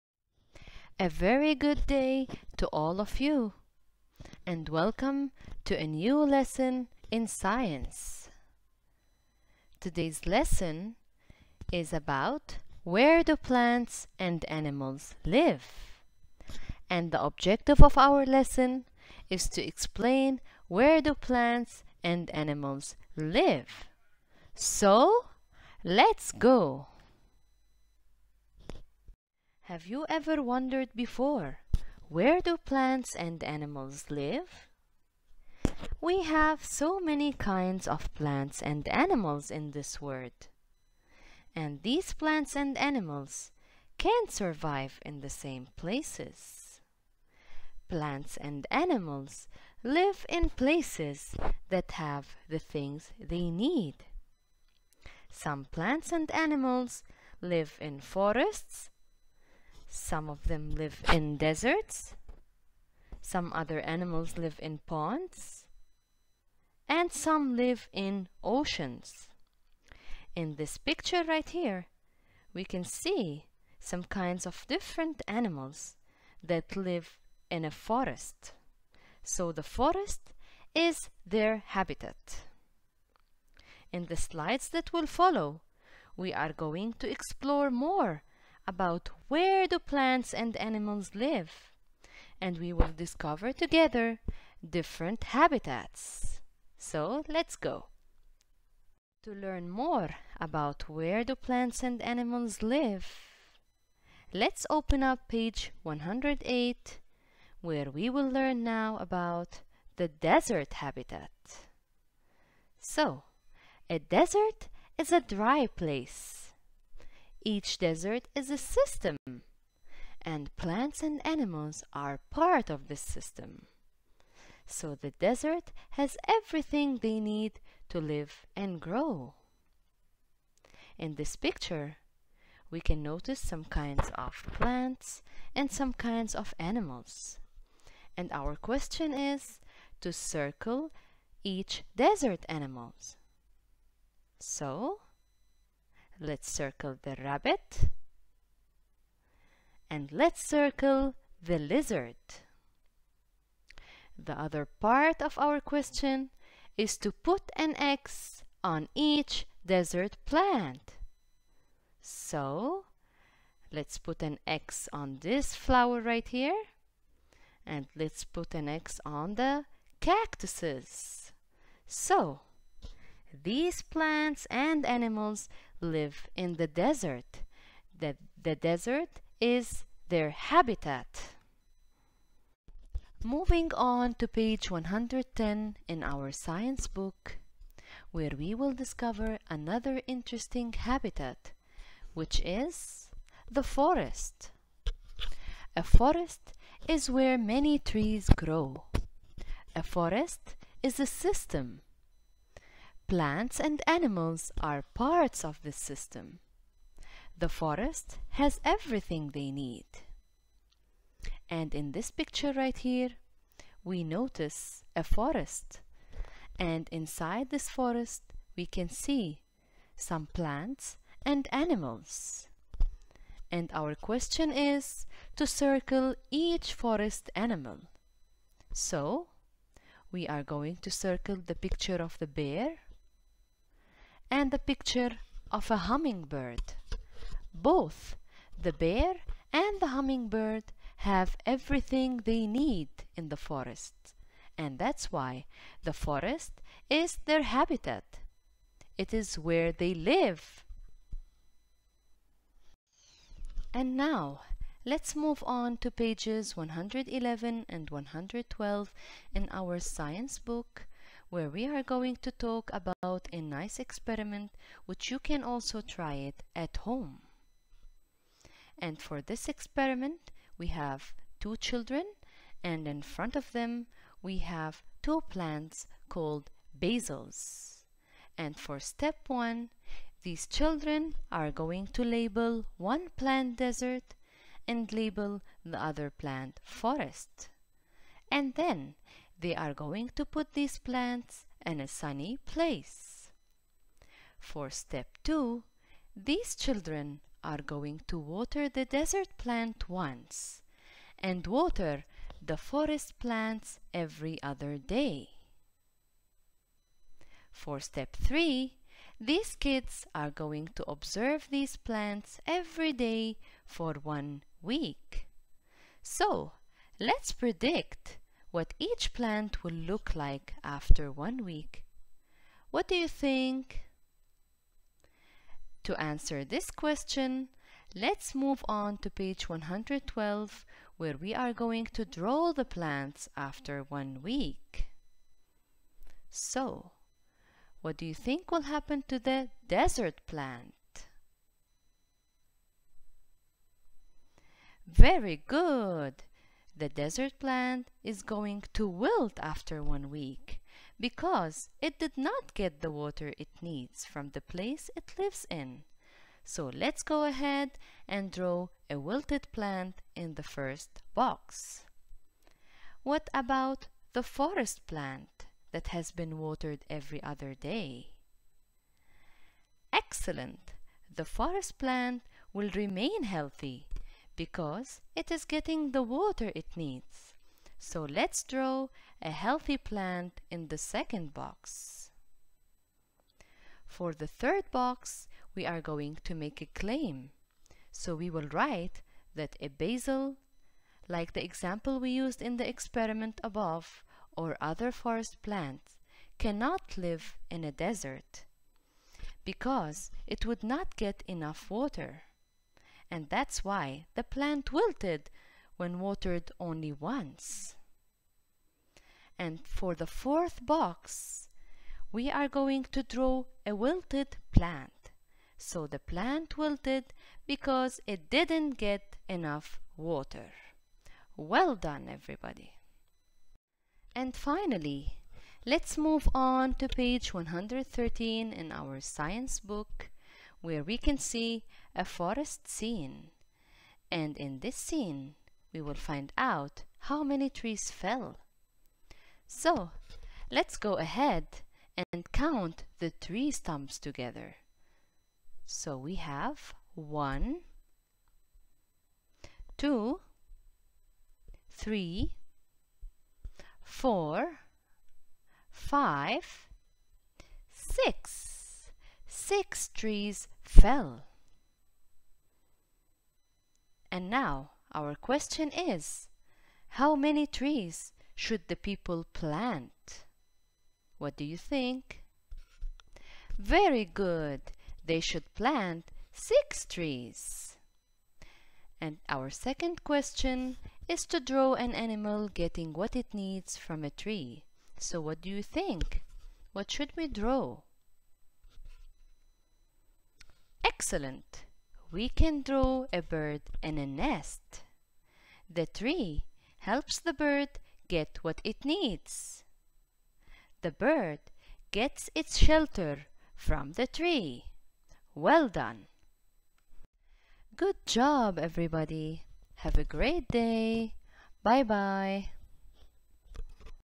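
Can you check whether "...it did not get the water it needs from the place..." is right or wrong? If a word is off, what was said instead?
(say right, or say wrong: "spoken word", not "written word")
right.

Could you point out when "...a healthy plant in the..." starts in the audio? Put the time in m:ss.
6:19.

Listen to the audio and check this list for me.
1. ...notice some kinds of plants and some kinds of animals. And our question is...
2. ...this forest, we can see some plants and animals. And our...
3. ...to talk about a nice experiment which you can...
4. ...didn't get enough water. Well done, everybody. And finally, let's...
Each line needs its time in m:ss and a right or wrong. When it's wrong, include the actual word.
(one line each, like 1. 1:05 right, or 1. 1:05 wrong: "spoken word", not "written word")
1. 2:13 right
2. 3:37 right
3. 4:22 right
4. 6:58 right.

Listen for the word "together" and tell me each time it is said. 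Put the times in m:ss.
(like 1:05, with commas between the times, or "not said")
1:33, 7:23.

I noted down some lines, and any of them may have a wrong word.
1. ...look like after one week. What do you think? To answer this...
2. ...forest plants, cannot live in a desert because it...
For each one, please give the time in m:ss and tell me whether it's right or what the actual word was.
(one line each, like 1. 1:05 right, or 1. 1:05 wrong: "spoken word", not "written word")
1. 5:19 right
2. 6:34 right.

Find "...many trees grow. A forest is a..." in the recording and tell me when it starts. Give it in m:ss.
3:17.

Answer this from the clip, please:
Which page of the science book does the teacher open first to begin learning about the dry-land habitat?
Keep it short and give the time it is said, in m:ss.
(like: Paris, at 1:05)
108, at 1:45.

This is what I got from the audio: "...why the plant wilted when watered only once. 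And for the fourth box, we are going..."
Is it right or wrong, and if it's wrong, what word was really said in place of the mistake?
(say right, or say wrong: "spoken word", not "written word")
right.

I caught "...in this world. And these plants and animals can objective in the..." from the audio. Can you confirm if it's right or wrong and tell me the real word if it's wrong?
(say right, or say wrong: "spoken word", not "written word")
wrong: "survive", not "objective".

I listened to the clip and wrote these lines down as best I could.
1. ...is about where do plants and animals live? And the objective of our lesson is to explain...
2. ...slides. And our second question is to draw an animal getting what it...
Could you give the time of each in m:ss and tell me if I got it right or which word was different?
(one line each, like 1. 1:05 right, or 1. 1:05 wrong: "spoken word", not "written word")
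1. 0:11 right
2. 7:56 wrong: "trees", not "slides".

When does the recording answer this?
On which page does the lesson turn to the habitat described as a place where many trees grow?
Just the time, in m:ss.
3:04.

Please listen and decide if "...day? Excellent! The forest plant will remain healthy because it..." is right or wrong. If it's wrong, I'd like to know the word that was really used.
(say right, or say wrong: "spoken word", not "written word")
right.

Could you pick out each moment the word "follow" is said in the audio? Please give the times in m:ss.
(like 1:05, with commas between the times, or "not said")
1:25.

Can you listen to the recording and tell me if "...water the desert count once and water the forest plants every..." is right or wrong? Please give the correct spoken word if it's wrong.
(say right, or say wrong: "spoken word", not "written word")
wrong: "plant", not "count".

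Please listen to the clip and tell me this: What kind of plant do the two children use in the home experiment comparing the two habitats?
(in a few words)
basil.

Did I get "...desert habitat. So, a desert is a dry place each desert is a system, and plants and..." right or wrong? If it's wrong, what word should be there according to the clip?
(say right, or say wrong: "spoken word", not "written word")
right.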